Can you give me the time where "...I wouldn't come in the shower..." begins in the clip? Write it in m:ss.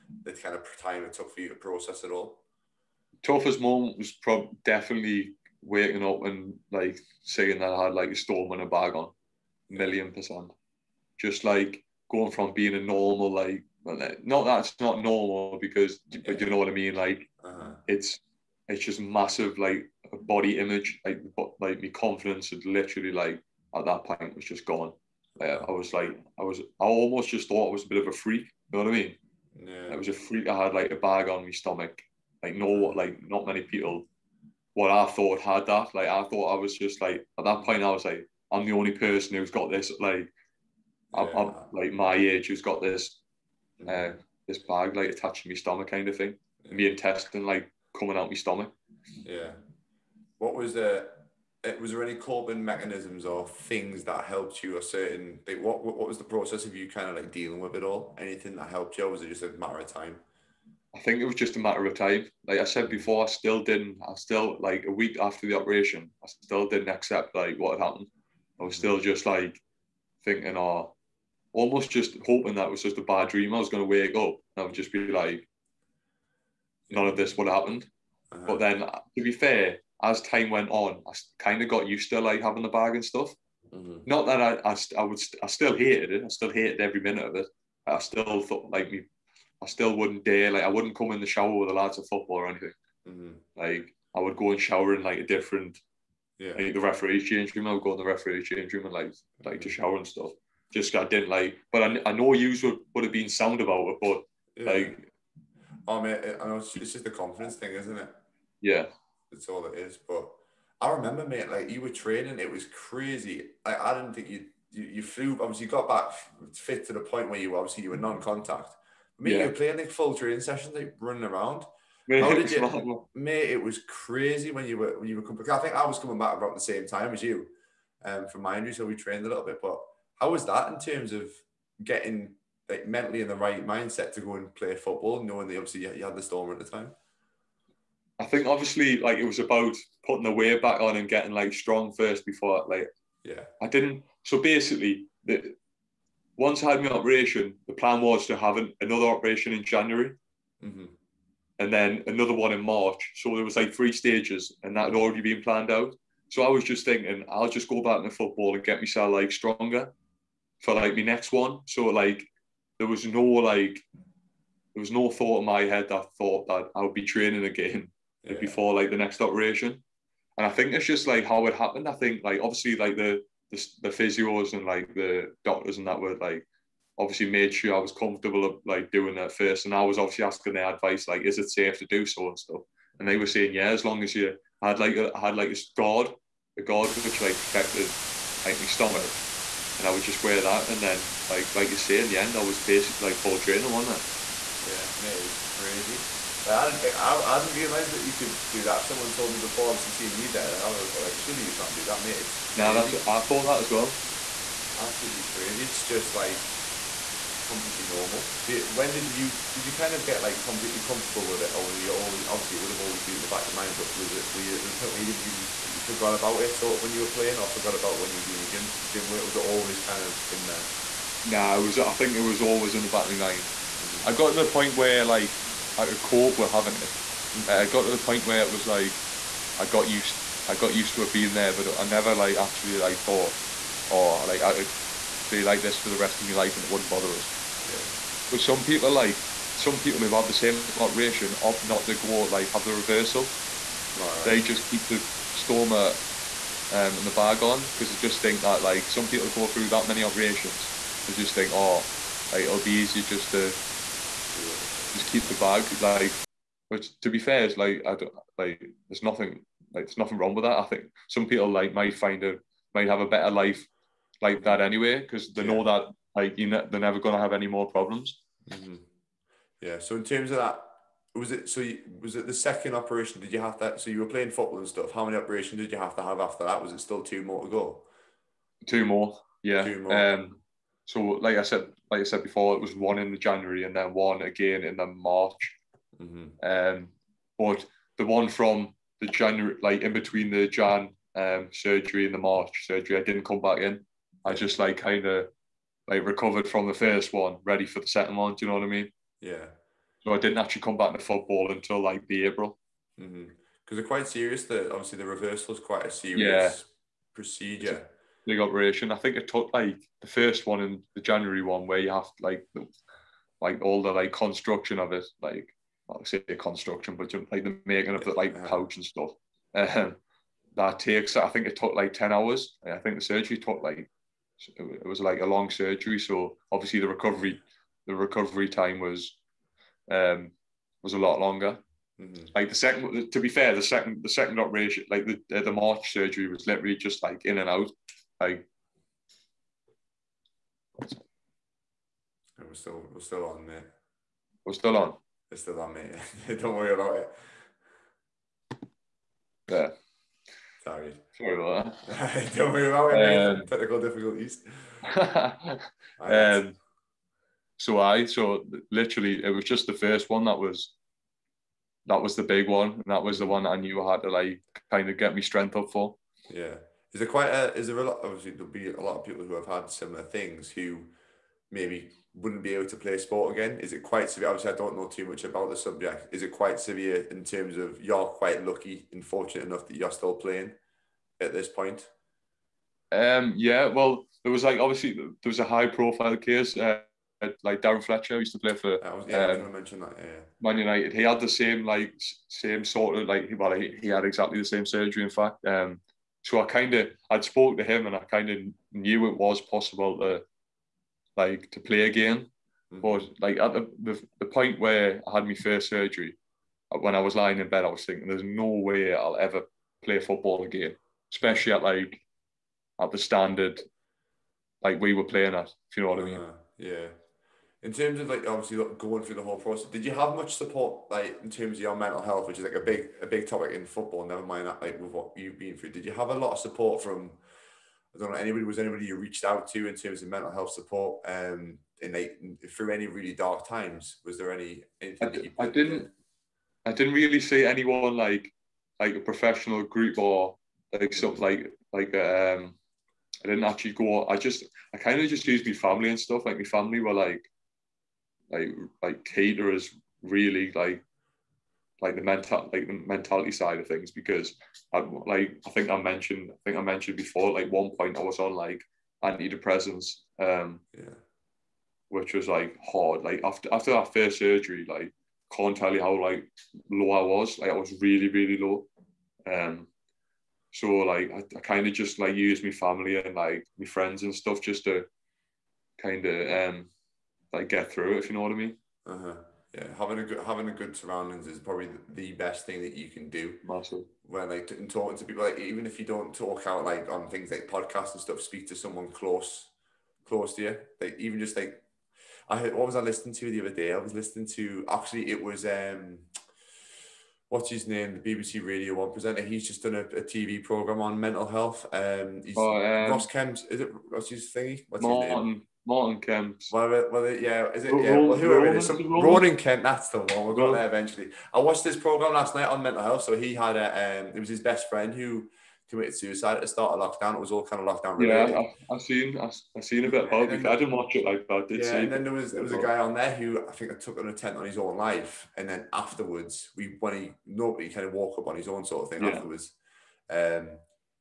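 1:30.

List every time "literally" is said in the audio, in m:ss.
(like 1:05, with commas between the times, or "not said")
0:22, 5:36, 5:58.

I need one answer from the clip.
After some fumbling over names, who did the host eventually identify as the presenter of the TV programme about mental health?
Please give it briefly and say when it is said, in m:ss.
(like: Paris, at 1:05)
Roman Kemp, at 8:28.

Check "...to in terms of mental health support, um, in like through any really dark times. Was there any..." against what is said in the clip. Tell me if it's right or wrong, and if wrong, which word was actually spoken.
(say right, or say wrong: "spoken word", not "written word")
right.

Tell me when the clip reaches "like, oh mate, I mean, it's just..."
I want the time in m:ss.
1:44.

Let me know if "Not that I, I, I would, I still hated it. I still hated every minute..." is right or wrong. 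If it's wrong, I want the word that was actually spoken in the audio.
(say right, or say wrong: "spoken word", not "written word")
right.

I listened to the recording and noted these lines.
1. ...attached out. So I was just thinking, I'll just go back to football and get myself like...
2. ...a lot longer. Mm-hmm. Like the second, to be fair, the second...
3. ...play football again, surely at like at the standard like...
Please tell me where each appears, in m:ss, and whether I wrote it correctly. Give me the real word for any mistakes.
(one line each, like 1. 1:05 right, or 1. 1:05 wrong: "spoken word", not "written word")
1. 2:35 wrong: "planned", not "attached"
2. 5:30 right
3. 6:49 wrong: "especially", not "surely".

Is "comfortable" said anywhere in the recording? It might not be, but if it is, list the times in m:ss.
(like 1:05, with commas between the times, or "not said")
2:57, 3:30.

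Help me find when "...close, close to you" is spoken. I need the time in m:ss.
8:08.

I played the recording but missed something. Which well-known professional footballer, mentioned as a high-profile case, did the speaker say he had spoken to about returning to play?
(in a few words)
Darren Fletcher.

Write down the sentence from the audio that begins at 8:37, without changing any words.
It was all kind of lockdown related.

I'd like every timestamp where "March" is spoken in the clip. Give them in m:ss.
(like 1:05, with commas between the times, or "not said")
2:32, 4:44, 4:52, 5:35.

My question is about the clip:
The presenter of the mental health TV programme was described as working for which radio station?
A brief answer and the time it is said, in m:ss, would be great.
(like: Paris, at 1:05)
BBC Radio One, at 8:18.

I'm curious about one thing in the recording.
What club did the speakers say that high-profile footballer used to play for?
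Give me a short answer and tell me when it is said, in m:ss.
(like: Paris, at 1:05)
Man United, at 6:30.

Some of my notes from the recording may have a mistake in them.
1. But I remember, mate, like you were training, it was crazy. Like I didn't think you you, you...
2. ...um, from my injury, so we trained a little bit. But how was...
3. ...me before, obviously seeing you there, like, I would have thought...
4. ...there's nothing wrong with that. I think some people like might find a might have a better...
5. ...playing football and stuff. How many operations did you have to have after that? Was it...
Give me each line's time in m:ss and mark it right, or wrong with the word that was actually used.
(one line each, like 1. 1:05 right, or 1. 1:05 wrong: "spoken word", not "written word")
1. 1:49 right
2. 2:08 right
3. 3:19 right
4. 4:19 right
5. 4:34 right.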